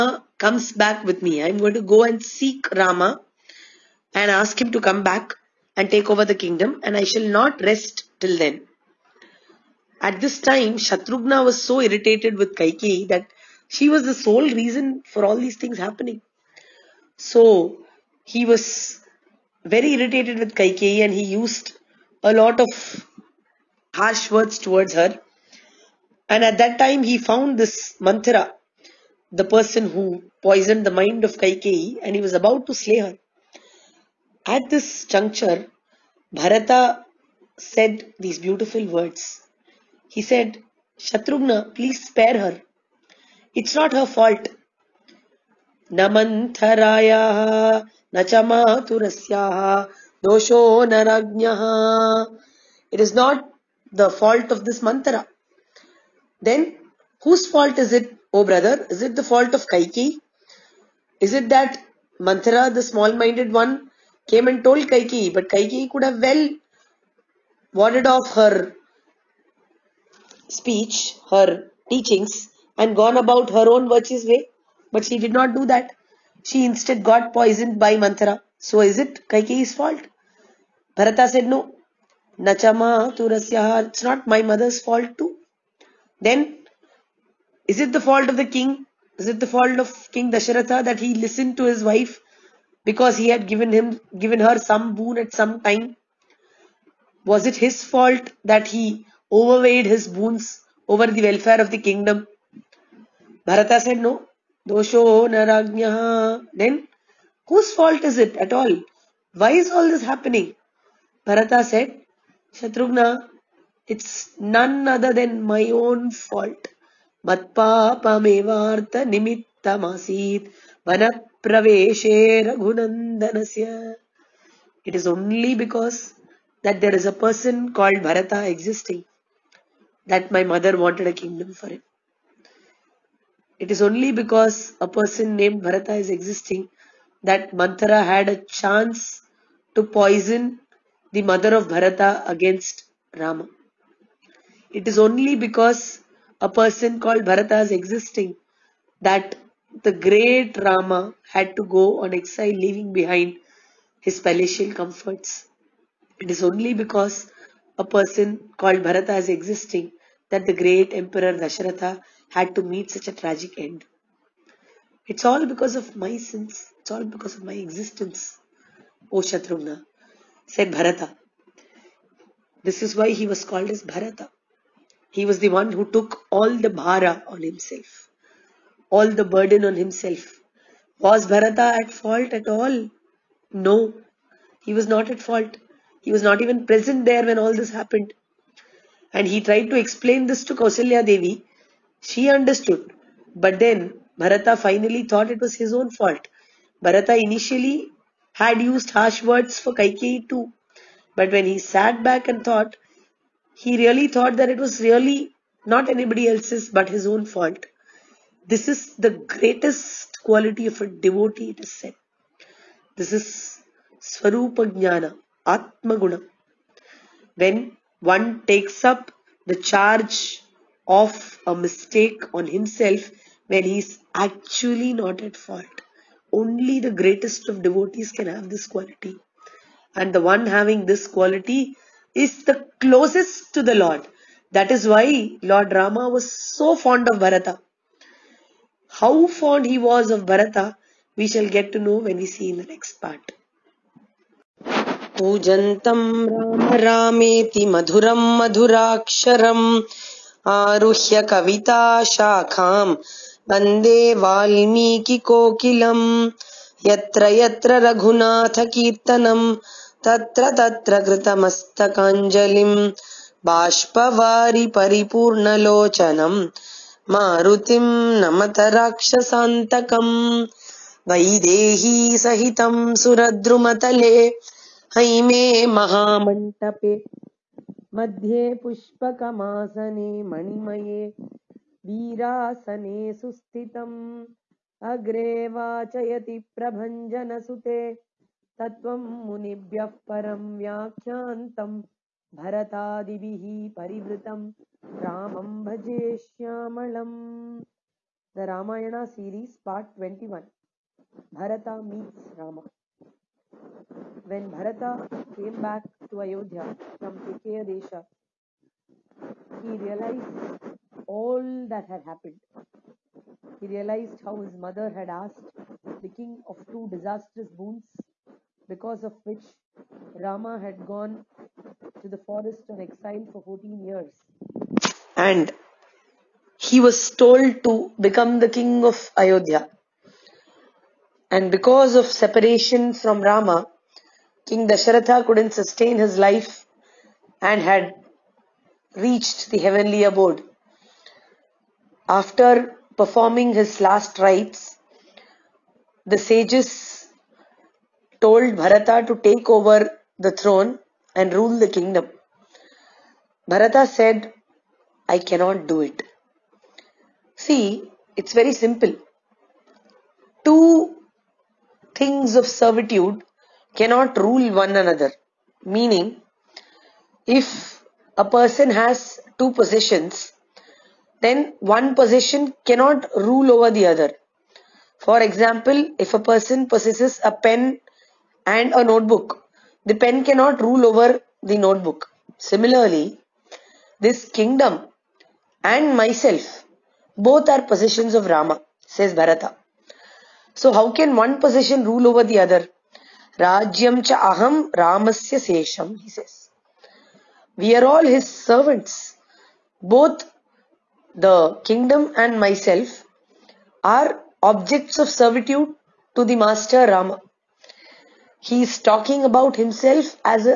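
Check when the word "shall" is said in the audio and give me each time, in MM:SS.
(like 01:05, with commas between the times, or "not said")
00:07, 04:01.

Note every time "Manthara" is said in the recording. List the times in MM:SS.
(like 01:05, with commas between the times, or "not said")
00:27, 01:17, 02:17.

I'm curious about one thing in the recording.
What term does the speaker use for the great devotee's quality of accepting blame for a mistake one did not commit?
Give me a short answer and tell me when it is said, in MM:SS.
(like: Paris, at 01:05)
Swarupa Jnana, Atmaguna, at 03:33.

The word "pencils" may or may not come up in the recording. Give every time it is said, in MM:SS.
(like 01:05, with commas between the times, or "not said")
not said.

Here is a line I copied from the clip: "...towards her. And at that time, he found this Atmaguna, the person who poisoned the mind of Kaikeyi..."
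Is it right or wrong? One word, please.
wrong.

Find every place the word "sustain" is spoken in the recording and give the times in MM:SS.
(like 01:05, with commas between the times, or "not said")
05:35.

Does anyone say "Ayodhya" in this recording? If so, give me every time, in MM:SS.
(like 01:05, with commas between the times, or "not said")
05:06, 05:29.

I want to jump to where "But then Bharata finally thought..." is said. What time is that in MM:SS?
03:13.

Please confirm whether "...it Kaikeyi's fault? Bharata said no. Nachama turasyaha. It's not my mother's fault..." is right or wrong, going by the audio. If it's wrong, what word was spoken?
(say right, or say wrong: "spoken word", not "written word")
right.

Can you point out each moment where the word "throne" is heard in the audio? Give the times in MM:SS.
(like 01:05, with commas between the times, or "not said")
05:50.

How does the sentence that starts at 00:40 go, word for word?
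He said, Shatrughna, please spare her.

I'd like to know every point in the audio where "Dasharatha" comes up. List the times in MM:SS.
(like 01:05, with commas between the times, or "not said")
01:30, 02:41, 05:34.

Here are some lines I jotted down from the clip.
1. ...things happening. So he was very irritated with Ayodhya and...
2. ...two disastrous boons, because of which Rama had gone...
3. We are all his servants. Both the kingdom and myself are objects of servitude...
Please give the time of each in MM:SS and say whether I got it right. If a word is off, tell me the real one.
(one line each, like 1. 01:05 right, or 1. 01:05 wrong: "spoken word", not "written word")
1. 00:15 wrong: "Kaikeyi", not "Ayodhya"
2. 05:16 right
3. 06:37 right.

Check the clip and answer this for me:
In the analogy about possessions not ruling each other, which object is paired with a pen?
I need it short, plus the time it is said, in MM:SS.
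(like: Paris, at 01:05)
a notebook, at 06:18.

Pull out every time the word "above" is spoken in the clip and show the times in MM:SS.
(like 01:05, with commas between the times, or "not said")
not said.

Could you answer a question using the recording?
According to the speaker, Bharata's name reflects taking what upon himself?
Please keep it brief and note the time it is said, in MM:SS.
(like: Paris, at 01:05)
all the bhara, at 02:56.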